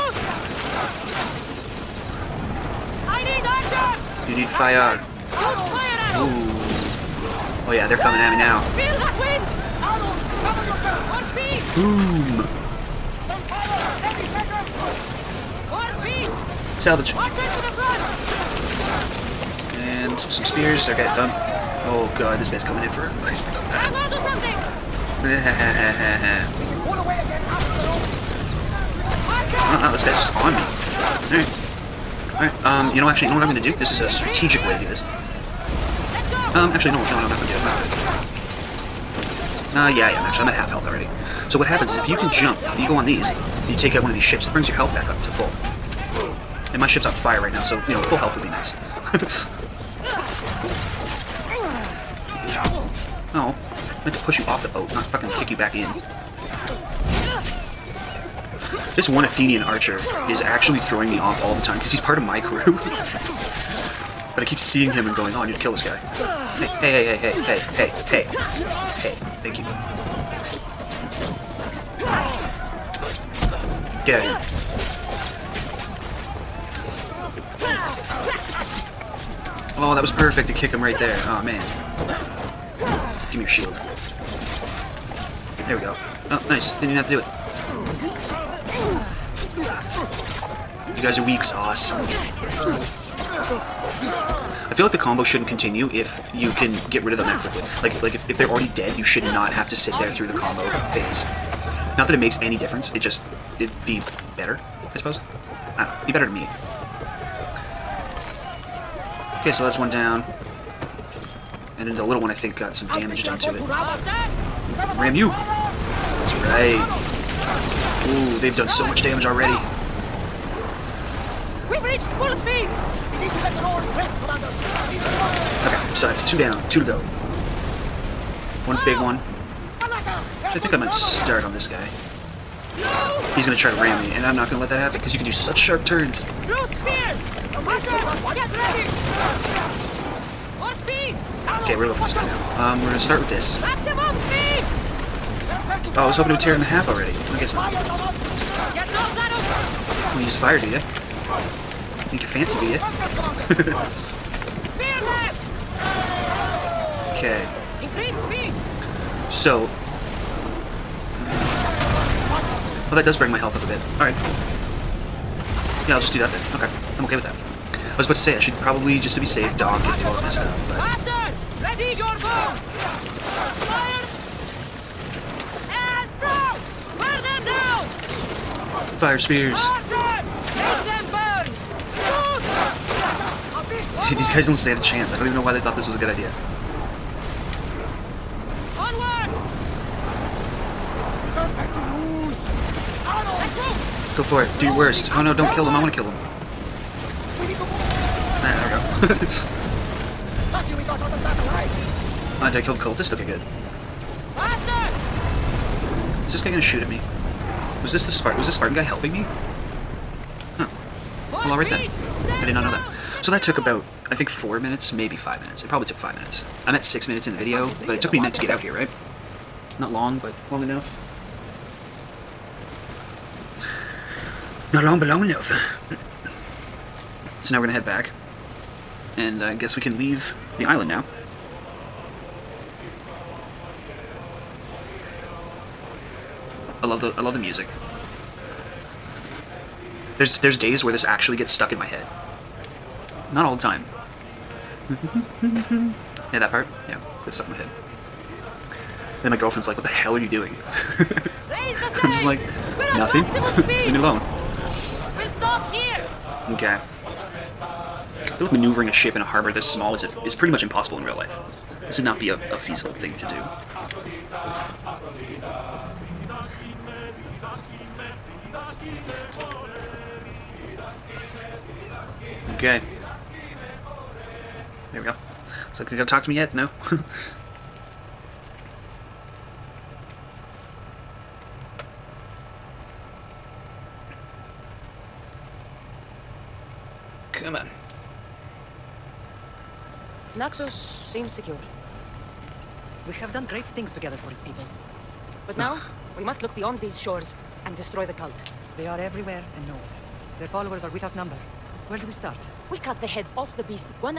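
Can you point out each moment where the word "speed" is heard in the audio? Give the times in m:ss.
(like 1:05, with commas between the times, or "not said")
2:02, 2:38.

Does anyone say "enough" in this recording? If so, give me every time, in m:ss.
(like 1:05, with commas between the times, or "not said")
3:40, 3:45.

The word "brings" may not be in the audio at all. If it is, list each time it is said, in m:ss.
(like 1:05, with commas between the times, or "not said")
0:44, 2:43.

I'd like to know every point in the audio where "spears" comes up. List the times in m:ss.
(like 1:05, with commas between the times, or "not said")
0:20, 2:59.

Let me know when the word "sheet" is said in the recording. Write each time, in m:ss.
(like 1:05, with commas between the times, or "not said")
not said.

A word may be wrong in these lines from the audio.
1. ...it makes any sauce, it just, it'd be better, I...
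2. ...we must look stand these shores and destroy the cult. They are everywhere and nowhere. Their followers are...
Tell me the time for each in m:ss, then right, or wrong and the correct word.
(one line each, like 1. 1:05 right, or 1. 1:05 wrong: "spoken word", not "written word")
1. 1:42 wrong: "difference", not "sauce"
2. 4:56 wrong: "beyond", not "stand".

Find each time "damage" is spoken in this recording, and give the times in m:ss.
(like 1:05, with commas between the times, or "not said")
1:52, 1:59.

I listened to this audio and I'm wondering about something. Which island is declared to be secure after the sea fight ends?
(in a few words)
Naxos.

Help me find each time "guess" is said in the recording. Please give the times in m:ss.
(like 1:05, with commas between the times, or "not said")
2:27, 3:49.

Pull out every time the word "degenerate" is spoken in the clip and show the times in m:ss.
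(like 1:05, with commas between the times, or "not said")
not said.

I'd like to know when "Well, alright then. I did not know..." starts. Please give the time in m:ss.
3:31.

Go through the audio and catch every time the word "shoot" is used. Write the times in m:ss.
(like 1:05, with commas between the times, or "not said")
3:26.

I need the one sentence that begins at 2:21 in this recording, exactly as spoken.
Okay, we're gonna go for this guy now.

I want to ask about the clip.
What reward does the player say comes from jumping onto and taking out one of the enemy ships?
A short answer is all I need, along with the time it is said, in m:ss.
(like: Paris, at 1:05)
full health, at 0:44.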